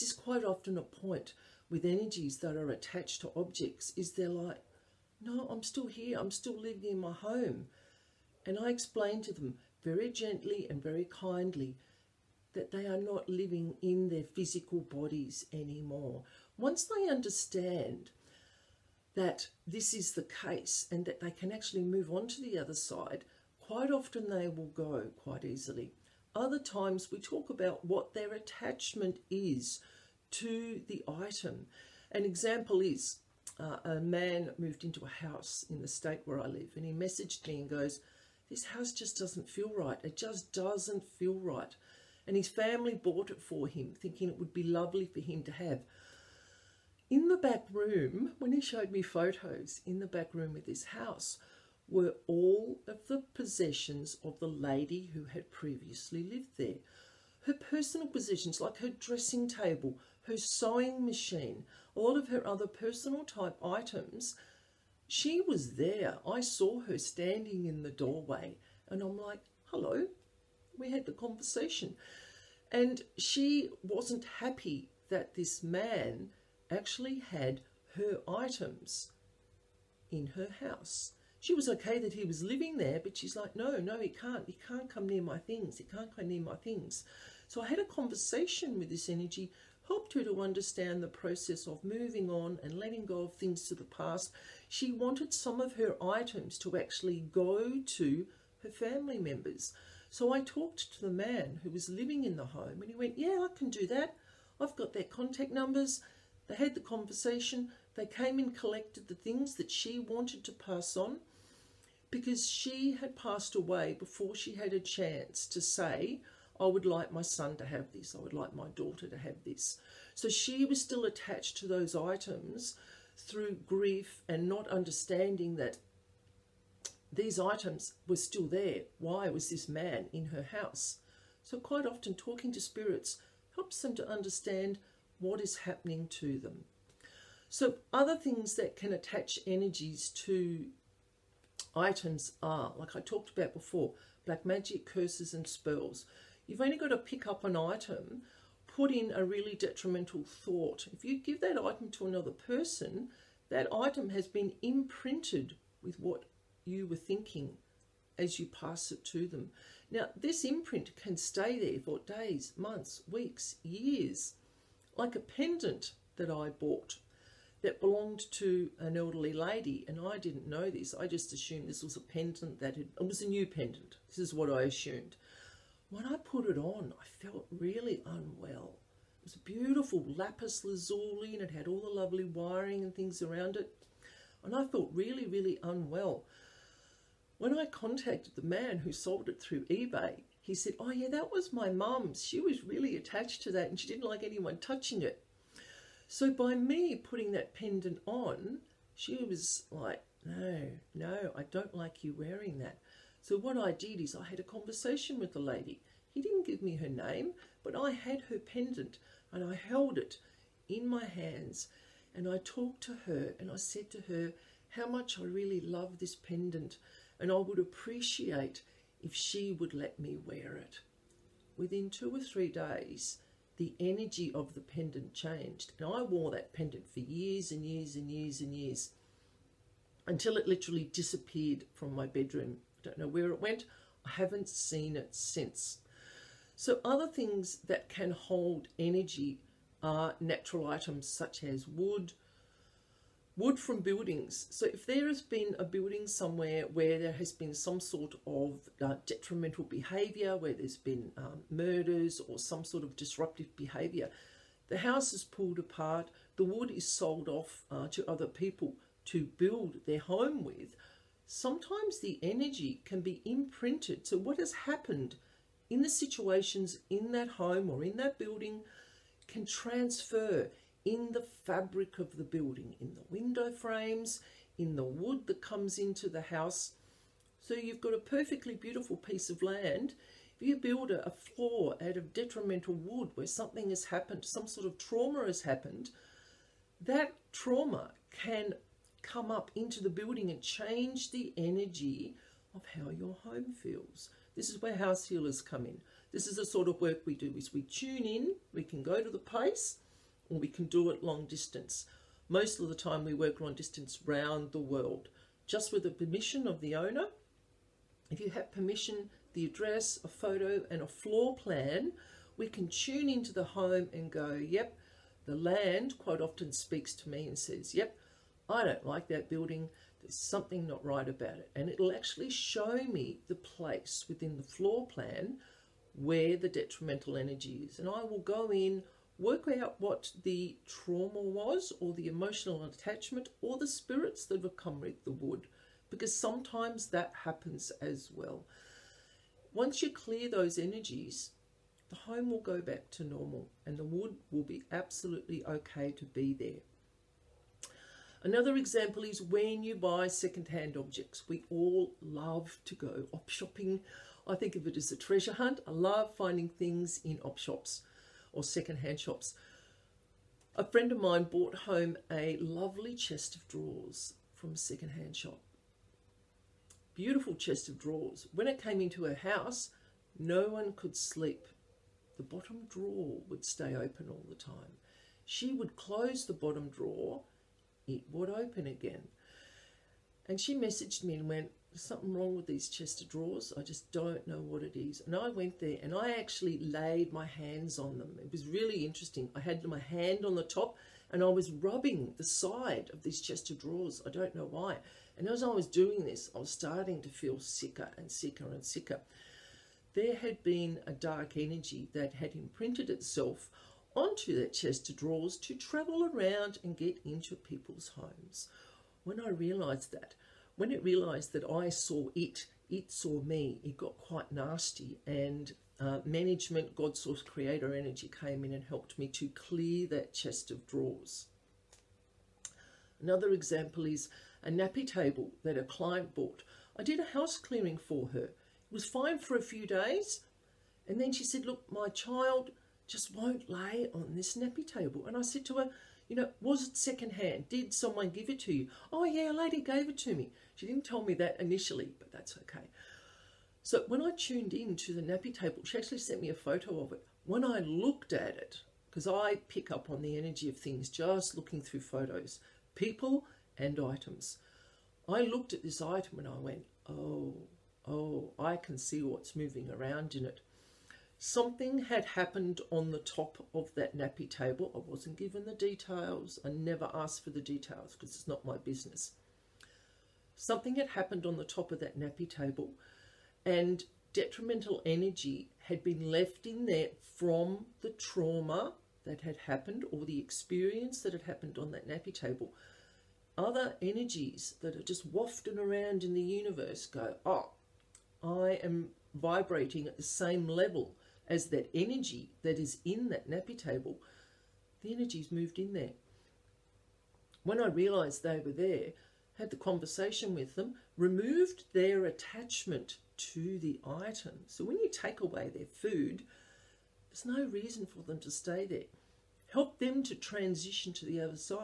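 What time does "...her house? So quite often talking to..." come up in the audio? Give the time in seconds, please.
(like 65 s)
130 s.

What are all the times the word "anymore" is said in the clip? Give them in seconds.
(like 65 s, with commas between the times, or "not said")
15 s.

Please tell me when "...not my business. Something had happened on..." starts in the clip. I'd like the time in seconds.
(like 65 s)
468 s.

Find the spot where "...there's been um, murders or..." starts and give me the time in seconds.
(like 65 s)
250 s.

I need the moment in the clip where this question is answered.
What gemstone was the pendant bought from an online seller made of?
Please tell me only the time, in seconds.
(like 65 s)
180 s.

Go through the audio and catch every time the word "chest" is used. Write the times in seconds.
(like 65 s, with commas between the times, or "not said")
362 s, 367 s, 382 s, 393 s, 404 s, 420 s.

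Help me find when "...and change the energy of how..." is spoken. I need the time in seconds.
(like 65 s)
290 s.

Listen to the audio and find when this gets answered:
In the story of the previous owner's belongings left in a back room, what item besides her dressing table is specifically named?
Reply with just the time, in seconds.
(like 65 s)
60 s.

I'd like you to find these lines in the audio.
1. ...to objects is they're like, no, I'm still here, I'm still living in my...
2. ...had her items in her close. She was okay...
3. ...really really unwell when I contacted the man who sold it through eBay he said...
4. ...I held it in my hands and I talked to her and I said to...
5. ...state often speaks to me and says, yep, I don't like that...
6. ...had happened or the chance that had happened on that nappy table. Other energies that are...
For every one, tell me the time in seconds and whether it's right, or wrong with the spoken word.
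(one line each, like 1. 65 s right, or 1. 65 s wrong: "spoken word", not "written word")
1. 3 s right
2. 77 s wrong: "house", not "close"
3. 184 s right
4. 209 s right
5. 315 s wrong: "quite", not "state"
6. 479 s wrong: "experience", not "chance".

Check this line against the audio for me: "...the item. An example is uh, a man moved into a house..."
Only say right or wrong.
right.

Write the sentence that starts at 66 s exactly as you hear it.
I saw her standing in the doorway and I'm like, hello, we had the conversation.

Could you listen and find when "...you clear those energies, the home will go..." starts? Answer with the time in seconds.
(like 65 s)
339 s.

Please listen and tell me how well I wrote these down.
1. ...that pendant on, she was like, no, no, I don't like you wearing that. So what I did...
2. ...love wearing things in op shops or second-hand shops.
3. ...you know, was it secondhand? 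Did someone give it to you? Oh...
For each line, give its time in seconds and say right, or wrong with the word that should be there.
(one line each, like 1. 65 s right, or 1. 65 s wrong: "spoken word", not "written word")
1. 197 s right
2. 355 s wrong: "finding", not "wearing"
3. 436 s right.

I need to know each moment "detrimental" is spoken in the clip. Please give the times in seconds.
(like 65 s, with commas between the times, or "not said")
149 s, 249 s, 282 s, 326 s, 474 s.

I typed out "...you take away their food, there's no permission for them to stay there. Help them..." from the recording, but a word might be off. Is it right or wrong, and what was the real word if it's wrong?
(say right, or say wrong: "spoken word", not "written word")
wrong: "reason", not "permission".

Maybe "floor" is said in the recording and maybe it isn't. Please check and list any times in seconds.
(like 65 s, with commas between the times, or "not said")
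281 s, 310 s, 324 s.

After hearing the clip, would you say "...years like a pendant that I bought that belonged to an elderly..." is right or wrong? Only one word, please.
right.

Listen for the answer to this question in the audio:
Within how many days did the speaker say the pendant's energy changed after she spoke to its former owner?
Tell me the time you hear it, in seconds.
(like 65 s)
221 s.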